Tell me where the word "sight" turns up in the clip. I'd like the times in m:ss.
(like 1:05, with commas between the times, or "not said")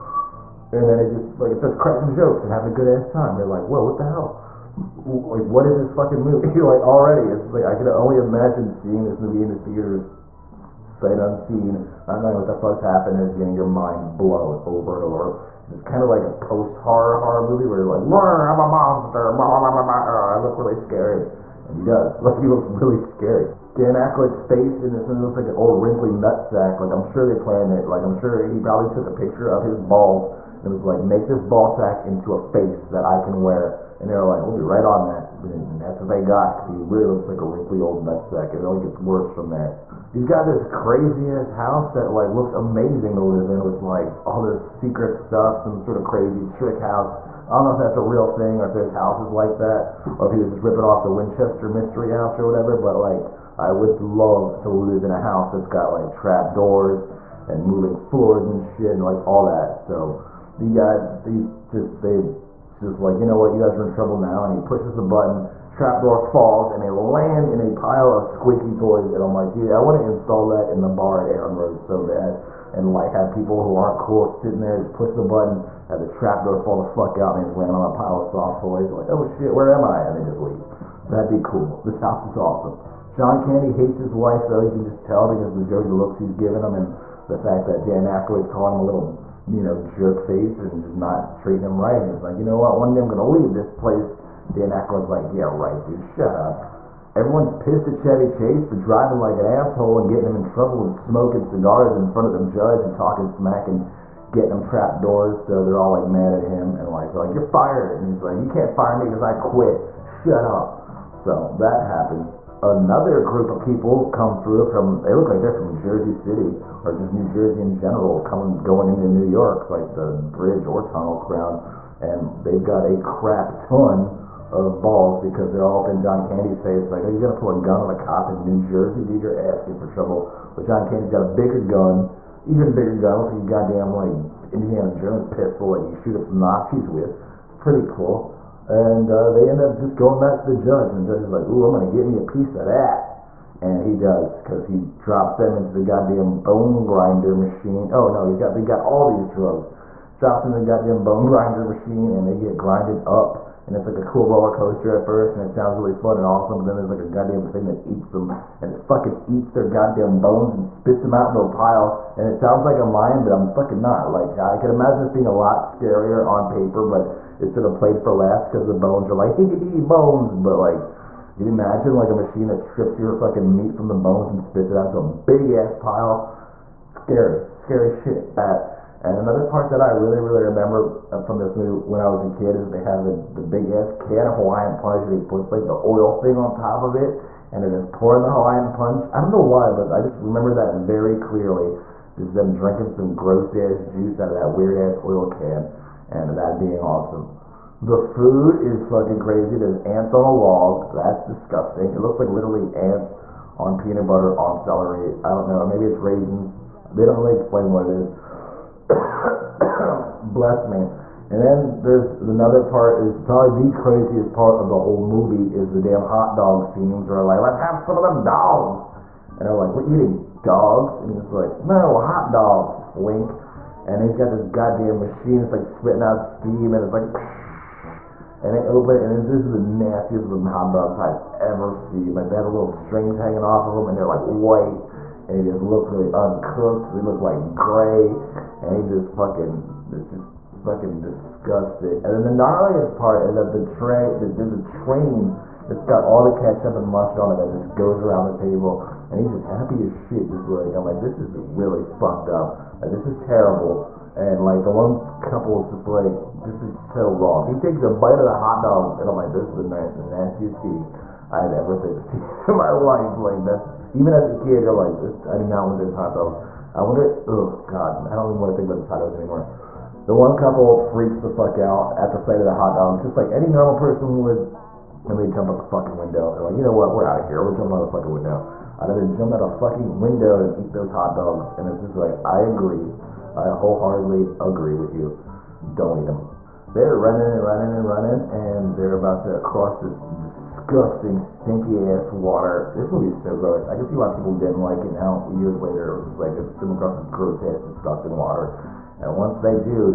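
0:10, 4:32.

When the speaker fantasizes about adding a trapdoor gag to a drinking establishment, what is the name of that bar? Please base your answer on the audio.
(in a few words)
Aaron Rose.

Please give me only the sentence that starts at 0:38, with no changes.
And it only gets worse from there.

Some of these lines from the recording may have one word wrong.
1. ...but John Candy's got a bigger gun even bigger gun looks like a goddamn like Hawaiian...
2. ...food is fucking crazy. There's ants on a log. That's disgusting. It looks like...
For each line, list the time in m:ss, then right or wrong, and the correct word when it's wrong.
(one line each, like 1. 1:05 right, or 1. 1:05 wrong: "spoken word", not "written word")
1. 2:10 wrong: "Indiana", not "Hawaiian"
2. 3:17 right.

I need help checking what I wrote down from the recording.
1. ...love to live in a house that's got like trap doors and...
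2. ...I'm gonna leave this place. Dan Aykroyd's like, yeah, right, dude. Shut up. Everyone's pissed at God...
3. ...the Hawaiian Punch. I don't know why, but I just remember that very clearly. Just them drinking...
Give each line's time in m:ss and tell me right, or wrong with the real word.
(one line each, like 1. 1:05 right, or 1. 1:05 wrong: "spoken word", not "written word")
1. 0:53 right
2. 1:33 wrong: "Chevy", not "God"
3. 3:08 right.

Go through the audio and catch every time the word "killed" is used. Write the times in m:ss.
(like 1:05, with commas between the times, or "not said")
not said.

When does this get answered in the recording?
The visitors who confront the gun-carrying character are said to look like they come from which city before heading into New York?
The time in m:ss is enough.
1:55.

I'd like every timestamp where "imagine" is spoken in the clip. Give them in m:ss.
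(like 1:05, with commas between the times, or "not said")
0:08, 2:44, 2:51.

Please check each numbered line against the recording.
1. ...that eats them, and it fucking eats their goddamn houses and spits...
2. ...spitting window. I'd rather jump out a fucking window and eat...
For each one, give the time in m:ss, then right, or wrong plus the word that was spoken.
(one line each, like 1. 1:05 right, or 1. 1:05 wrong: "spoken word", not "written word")
1. 2:37 wrong: "bones", not "houses"
2. 4:37 wrong: "fucking", not "spitting".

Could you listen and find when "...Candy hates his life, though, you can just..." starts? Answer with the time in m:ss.
1:23.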